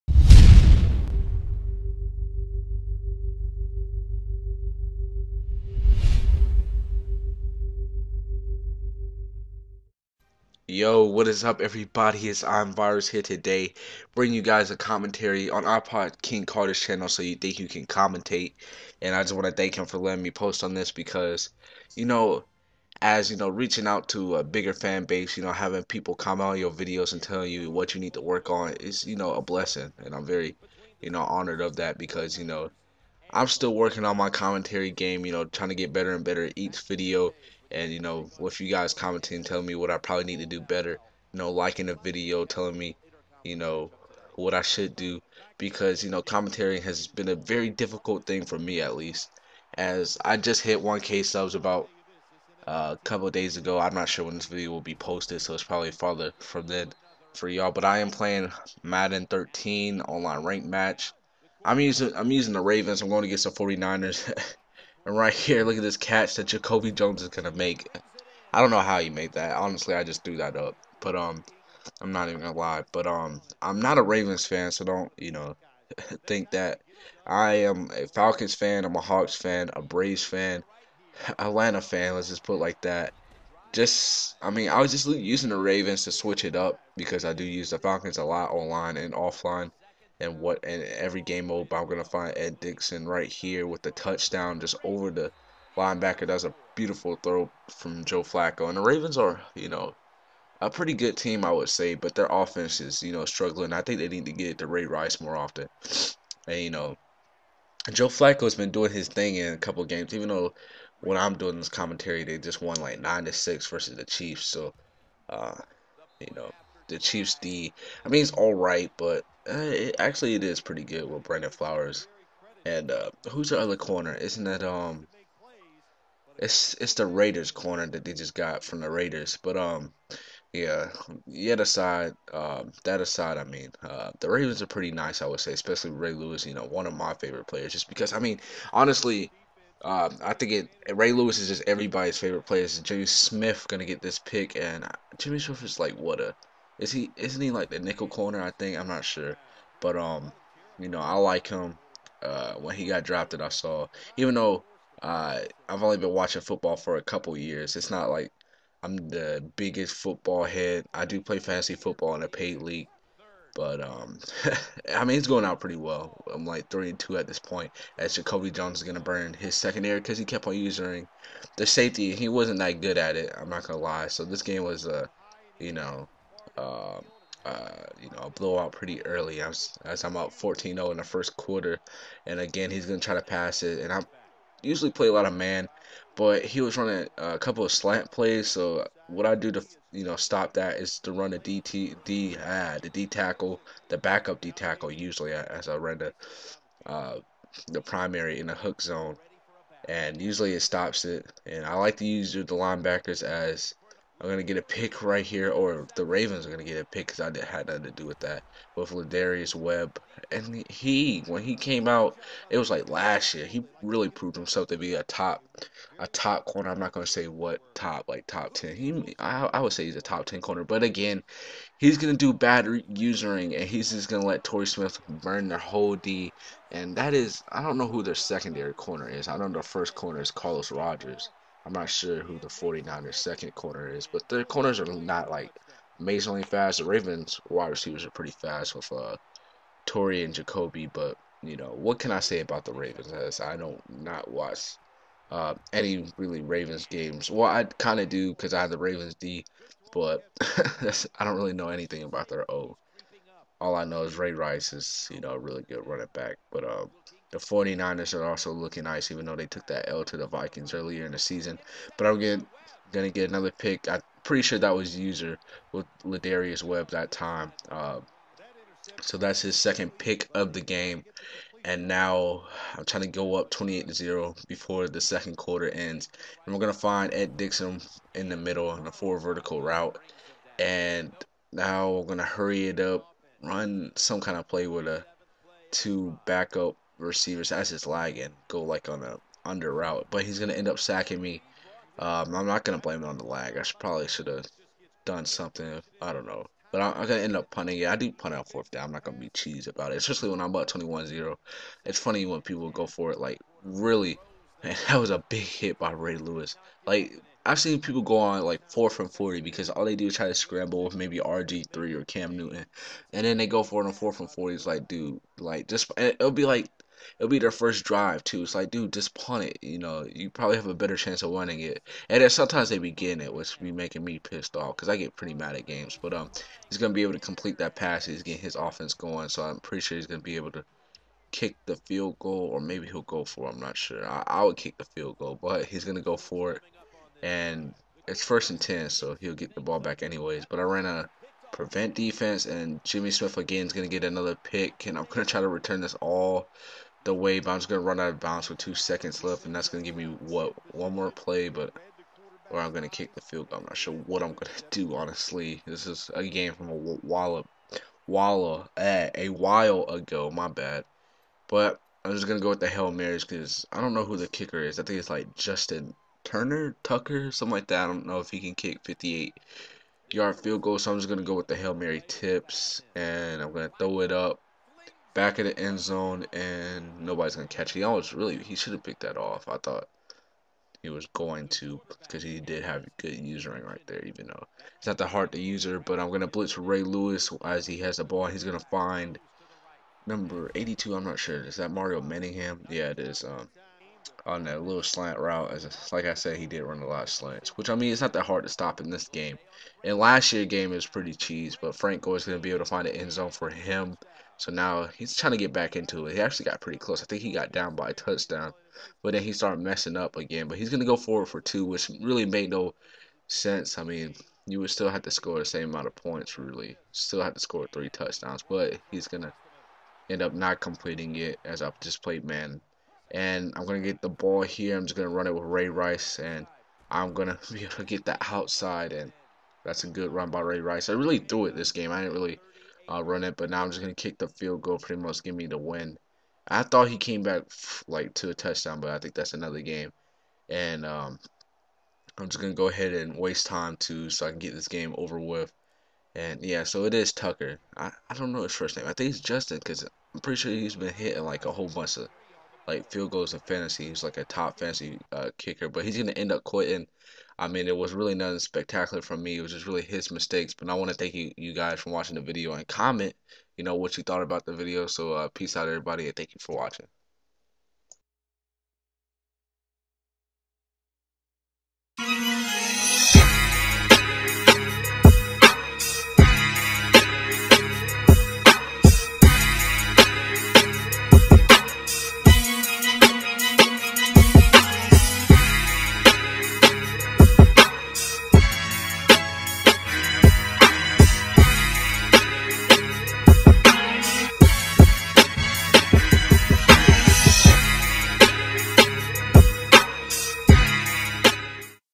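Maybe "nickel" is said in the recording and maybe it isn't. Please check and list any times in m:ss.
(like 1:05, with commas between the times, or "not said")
2:27.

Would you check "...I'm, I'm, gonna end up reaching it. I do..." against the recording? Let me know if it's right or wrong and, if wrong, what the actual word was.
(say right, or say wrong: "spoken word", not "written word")
wrong: "punting", not "reaching".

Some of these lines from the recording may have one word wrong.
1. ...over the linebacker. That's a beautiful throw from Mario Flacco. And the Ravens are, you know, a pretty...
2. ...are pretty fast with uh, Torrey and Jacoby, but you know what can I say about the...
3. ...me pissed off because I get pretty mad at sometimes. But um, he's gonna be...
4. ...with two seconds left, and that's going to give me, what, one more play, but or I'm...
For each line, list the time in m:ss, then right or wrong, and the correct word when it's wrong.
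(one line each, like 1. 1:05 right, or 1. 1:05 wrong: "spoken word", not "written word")
1. 1:34 wrong: "Joe", not "Mario"
2. 3:58 right
3. 5:24 wrong: "games", not "sometimes"
4. 5:48 right.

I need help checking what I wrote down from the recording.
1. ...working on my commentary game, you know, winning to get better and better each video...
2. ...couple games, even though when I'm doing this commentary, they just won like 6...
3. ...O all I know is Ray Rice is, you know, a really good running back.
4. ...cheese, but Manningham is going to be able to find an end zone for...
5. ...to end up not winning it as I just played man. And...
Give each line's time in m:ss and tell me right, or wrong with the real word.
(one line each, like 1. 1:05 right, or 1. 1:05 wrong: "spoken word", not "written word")
1. 0:33 wrong: "trying", not "winning"
2. 1:49 wrong: "9", not "6"
3. 4:12 right
4. 6:41 wrong: "Franco", not "Manningham"
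5. 6:59 wrong: "completing", not "winning".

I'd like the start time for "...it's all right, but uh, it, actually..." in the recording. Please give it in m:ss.
1:58.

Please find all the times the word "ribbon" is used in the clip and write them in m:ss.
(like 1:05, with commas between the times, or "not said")
not said.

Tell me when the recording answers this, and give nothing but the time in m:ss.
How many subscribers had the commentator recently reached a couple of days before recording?
0:50.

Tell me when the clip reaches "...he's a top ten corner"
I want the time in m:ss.
3:39.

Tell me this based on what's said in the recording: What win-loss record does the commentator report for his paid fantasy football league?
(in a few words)
3 and 2.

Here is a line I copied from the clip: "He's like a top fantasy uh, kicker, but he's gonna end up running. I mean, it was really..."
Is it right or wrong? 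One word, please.
wrong.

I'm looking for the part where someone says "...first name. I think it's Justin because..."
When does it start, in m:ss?
7:28.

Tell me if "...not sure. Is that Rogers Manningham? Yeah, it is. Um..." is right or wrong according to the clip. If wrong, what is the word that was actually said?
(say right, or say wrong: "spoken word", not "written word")
wrong: "Mario", not "Rogers".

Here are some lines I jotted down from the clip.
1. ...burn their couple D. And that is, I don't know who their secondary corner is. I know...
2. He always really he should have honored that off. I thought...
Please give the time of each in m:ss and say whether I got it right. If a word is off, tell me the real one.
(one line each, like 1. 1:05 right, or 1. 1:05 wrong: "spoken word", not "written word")
1. 3:45 wrong: "whole", not "couple"
2. 6:17 wrong: "picked", not "honored".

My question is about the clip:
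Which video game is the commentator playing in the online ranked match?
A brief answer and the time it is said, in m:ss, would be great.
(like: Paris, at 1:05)
Madden 13, at 0:58.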